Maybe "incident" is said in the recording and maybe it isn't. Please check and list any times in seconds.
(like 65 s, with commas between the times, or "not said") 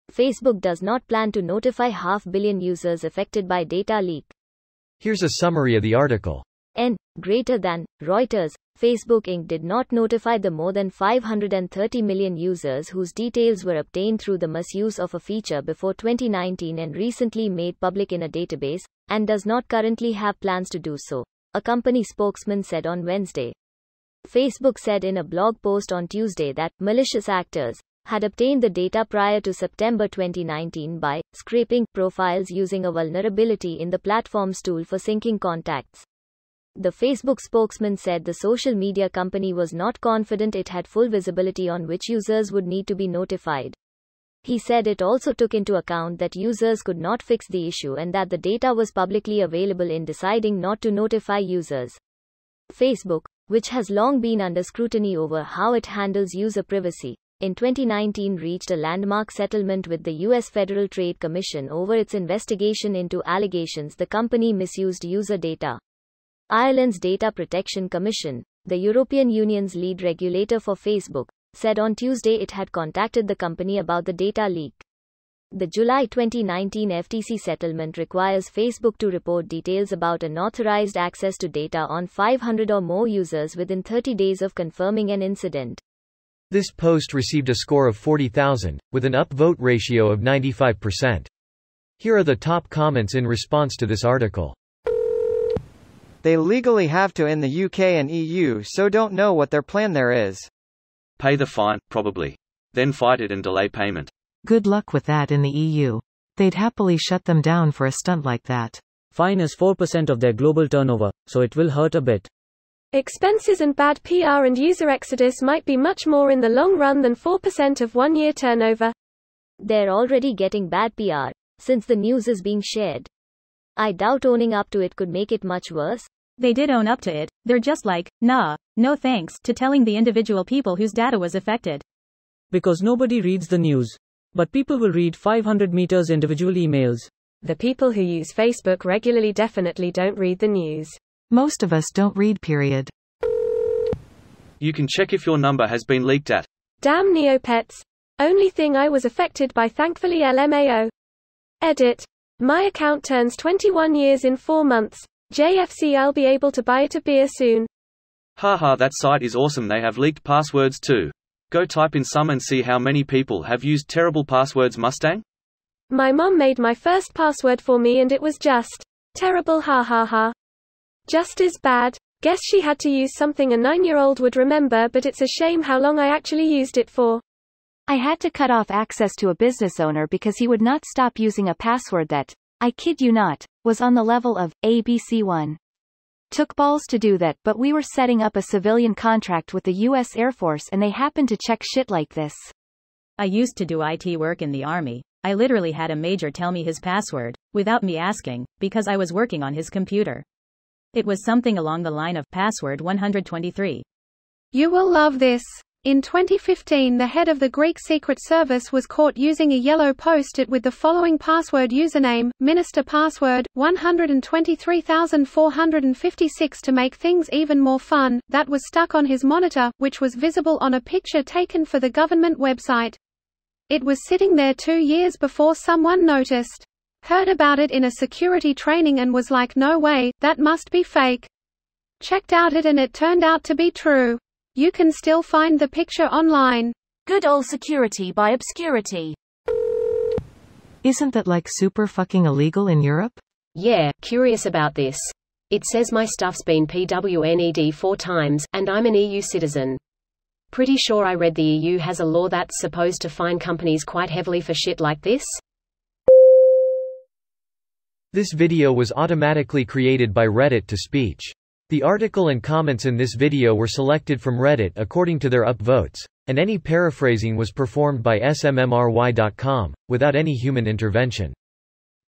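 85 s.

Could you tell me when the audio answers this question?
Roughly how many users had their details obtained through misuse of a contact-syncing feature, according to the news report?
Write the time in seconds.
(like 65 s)
10 s.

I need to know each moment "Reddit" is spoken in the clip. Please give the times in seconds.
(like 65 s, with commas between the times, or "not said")
260 s, 264 s.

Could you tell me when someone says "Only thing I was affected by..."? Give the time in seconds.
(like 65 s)
148 s.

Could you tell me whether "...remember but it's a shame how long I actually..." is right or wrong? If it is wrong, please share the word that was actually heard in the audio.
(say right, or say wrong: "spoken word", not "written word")
right.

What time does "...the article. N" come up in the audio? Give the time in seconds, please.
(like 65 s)
5 s.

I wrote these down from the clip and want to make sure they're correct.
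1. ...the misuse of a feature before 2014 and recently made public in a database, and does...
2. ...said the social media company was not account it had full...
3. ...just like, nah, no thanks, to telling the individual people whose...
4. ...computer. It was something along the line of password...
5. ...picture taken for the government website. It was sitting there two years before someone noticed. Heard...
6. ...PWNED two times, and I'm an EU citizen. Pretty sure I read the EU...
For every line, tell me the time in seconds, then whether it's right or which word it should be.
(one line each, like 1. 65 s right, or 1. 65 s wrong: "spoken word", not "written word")
1. 14 s wrong: "2019", not "2014"
2. 37 s wrong: "confident", not "account"
3. 127 s right
4. 199 s right
5. 220 s right
6. 246 s wrong: "four", not "two".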